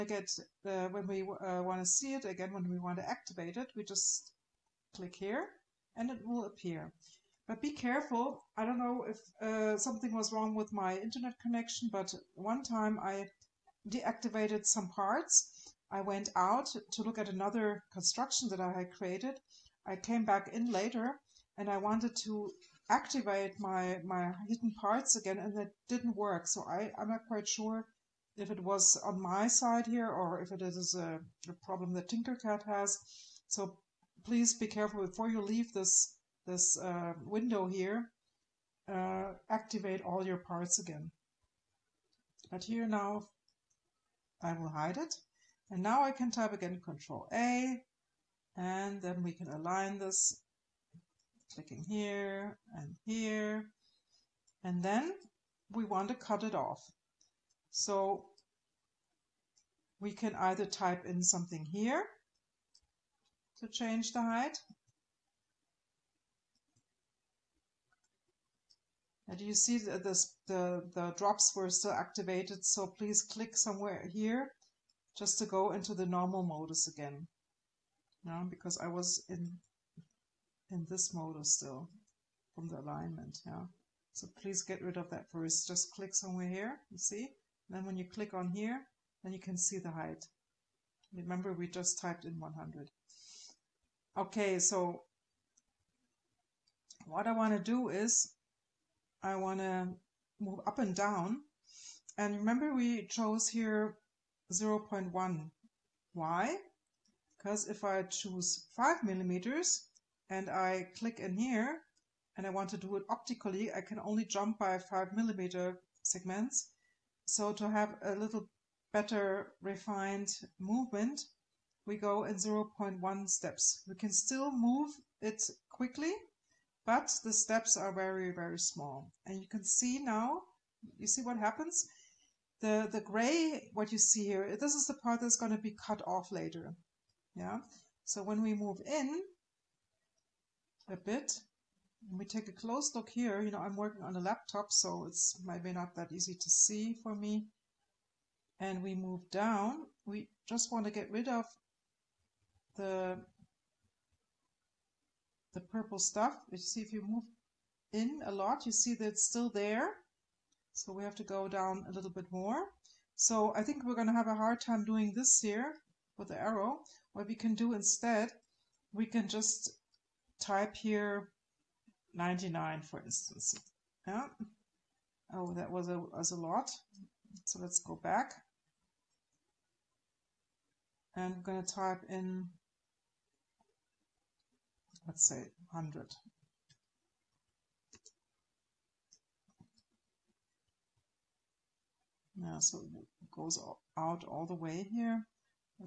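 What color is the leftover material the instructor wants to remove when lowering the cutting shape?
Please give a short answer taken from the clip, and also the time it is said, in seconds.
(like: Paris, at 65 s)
purple, at 155 s.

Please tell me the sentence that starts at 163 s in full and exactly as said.
So I think we're going to have a hard time doing this here with the arrow.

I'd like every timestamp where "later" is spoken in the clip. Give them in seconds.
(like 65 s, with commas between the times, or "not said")
20 s, 136 s.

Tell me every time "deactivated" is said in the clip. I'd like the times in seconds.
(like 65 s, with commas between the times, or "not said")
13 s.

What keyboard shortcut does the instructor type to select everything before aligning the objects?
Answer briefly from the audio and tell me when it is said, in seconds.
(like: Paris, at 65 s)
Control A, at 46 s.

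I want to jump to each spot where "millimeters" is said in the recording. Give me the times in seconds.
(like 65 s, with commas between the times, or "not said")
109 s, 115 s.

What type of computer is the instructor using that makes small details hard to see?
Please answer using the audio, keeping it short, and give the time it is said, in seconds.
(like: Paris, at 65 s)
laptop, at 144 s.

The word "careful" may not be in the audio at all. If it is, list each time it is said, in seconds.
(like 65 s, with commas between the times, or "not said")
7 s, 34 s.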